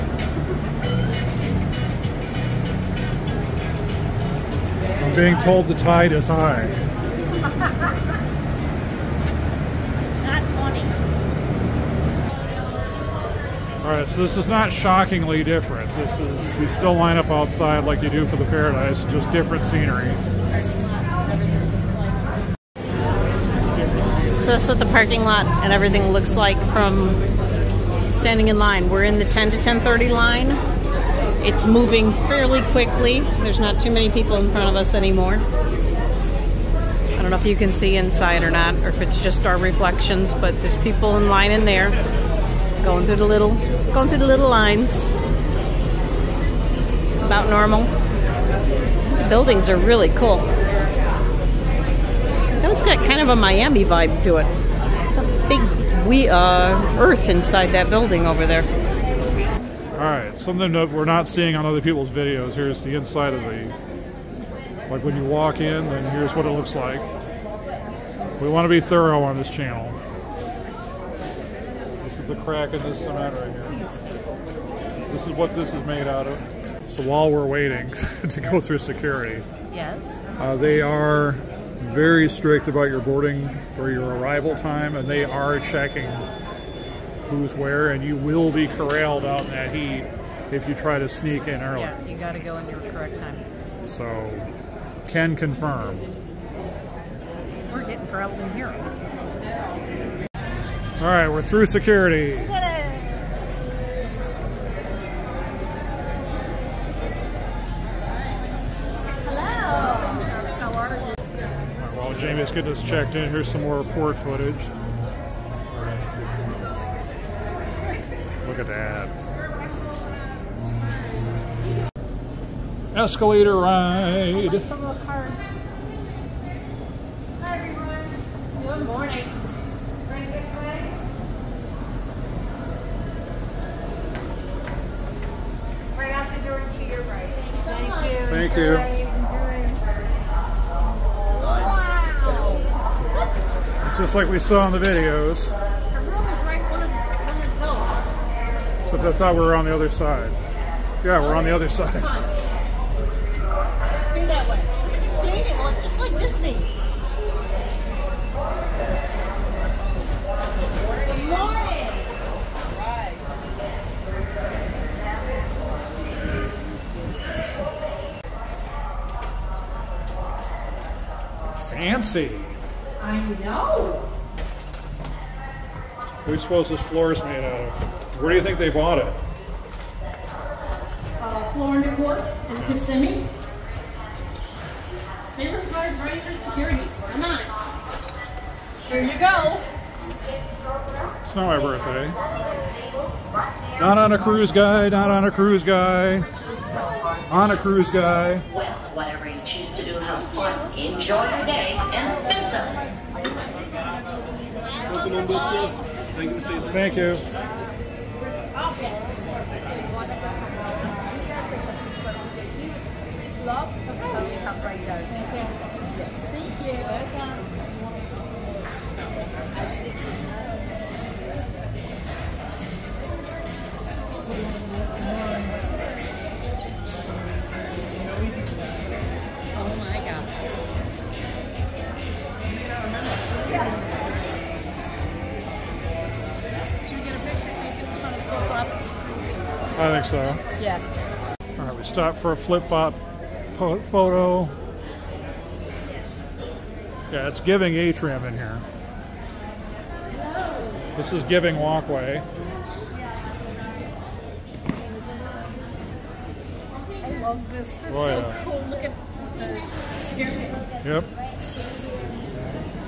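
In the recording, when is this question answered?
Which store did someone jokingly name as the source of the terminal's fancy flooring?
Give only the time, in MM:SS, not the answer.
03:01.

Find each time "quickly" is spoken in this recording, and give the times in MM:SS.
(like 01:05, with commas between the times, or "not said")
00:32.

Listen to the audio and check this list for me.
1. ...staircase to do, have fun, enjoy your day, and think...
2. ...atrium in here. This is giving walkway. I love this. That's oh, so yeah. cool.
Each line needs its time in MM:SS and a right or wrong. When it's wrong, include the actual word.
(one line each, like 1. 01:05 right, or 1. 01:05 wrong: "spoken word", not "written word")
1. 03:19 wrong: "choose", not "staircase"
2. 04:07 right.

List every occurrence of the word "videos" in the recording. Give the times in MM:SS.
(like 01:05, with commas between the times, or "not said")
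01:02, 02:24.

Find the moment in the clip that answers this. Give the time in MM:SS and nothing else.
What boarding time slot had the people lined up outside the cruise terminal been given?
00:29.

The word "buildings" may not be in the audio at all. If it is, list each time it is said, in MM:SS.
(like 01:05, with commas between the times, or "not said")
00:49, 00:57.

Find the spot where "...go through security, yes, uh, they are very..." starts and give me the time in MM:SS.
01:18.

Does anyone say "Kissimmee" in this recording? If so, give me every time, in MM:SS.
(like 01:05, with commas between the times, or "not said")
03:02.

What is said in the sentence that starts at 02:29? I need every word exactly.
but thought we were on the other side.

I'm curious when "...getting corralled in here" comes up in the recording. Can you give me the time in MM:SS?
01:37.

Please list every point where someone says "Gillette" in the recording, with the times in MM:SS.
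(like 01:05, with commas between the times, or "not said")
not said.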